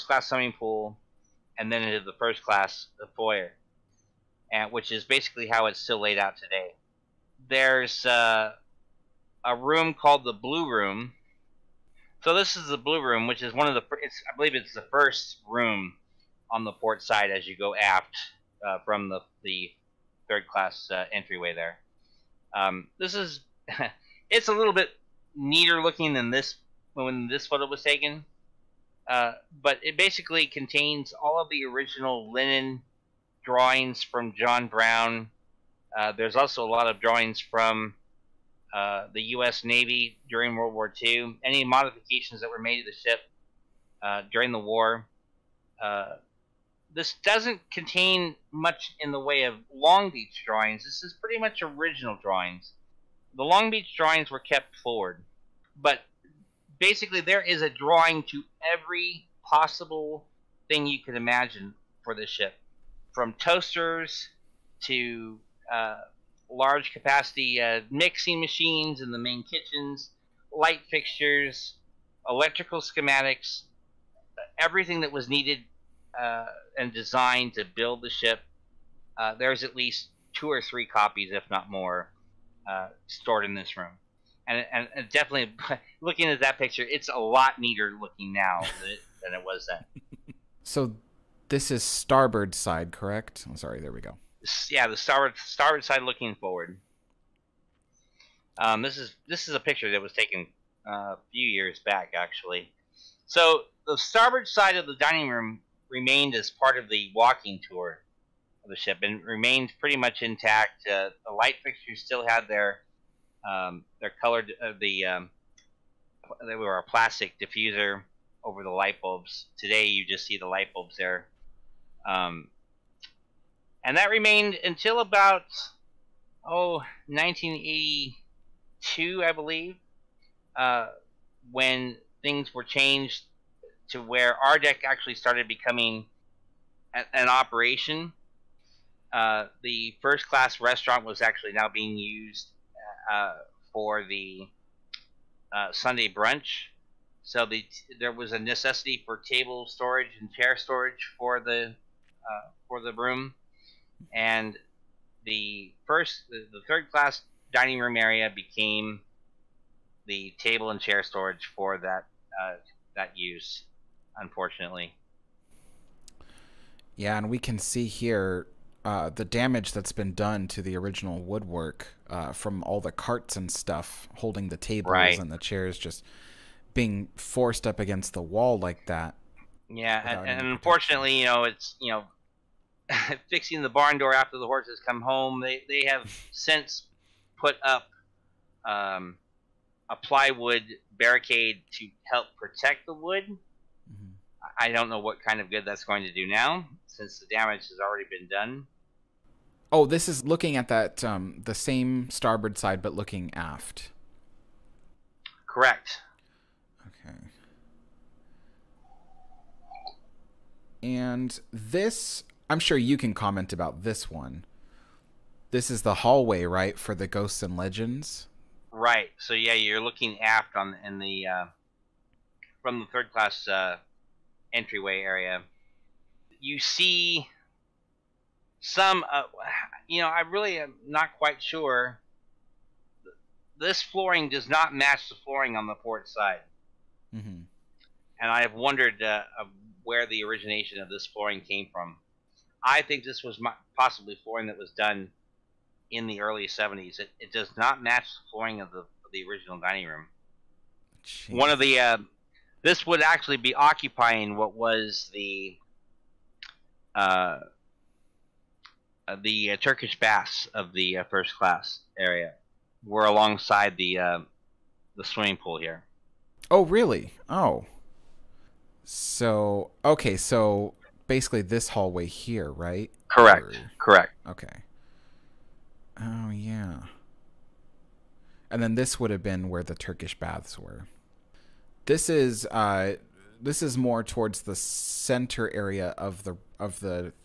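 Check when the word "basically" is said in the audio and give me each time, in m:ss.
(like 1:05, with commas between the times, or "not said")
0:05, 0:29, 0:56, 4:31.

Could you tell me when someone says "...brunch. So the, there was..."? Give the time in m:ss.
2:26.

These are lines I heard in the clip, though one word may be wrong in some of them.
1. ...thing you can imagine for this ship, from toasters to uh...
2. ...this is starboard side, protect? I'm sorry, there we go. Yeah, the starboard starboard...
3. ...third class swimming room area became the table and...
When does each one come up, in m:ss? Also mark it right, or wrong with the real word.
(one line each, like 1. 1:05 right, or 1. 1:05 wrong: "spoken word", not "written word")
1. 1:00 right
2. 1:31 wrong: "correct", not "protect"
3. 2:36 wrong: "dining", not "swimming".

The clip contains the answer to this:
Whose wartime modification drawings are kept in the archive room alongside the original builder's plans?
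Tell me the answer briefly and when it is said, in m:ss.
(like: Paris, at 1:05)
U.S. Navy, at 0:39.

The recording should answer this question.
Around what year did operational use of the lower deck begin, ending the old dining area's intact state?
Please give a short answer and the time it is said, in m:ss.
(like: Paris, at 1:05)
1982, at 2:07.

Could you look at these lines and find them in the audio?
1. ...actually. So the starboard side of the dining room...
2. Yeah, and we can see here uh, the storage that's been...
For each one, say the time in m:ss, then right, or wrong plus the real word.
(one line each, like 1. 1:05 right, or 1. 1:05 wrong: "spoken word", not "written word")
1. 1:42 right
2. 2:46 wrong: "damage", not "storage".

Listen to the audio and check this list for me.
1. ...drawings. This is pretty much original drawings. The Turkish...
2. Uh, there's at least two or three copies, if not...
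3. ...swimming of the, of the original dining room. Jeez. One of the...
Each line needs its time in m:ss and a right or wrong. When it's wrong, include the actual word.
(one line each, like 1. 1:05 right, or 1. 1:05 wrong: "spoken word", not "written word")
1. 0:50 wrong: "Long", not "Turkish"
2. 1:19 right
3. 4:08 wrong: "flooring", not "swimming".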